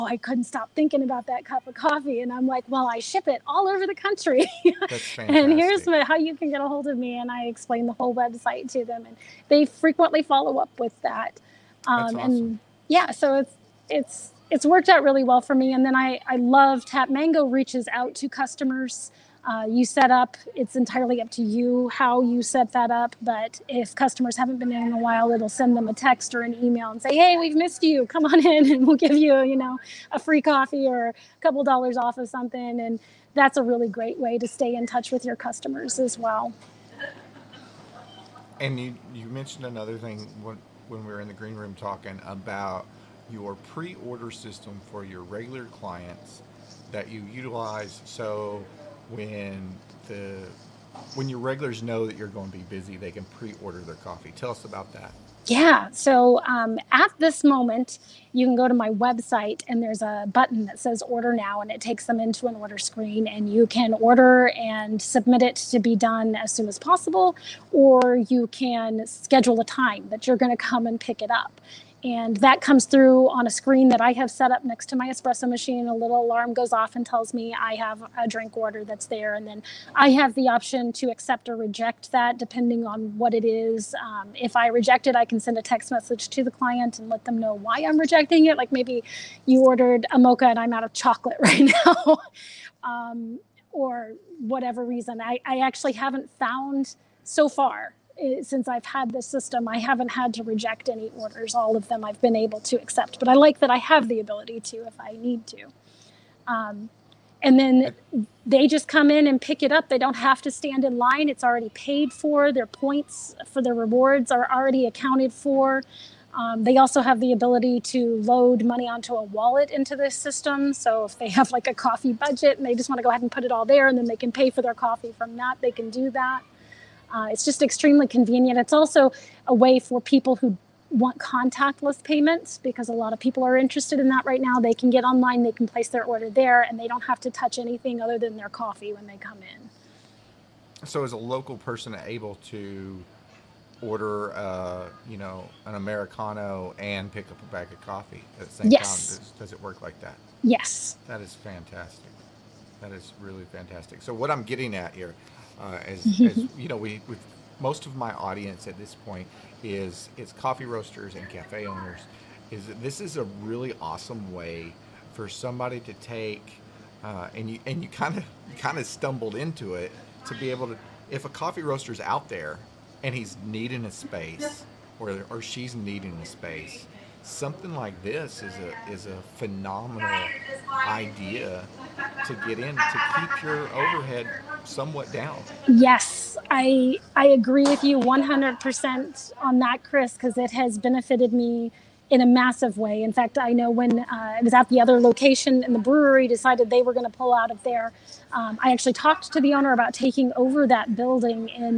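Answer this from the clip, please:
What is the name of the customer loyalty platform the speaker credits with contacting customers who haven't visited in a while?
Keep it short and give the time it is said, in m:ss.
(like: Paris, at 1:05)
Tap Mango, at 0:16.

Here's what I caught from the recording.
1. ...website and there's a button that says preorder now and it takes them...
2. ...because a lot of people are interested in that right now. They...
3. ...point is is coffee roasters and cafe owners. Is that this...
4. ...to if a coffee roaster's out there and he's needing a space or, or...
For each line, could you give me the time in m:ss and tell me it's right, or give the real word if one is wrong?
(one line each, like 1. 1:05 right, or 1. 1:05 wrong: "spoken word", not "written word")
1. 0:58 wrong: "order", not "preorder"
2. 2:12 right
3. 2:38 right
4. 2:50 right.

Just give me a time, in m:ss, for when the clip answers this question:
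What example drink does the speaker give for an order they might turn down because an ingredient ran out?
1:30.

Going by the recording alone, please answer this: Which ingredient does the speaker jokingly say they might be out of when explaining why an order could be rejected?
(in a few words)
Chocolate.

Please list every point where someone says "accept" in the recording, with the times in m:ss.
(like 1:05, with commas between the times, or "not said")
1:21, 1:42.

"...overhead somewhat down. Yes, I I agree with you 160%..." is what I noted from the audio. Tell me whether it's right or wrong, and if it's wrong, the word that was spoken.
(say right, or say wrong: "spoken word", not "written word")
wrong: "100", not "160".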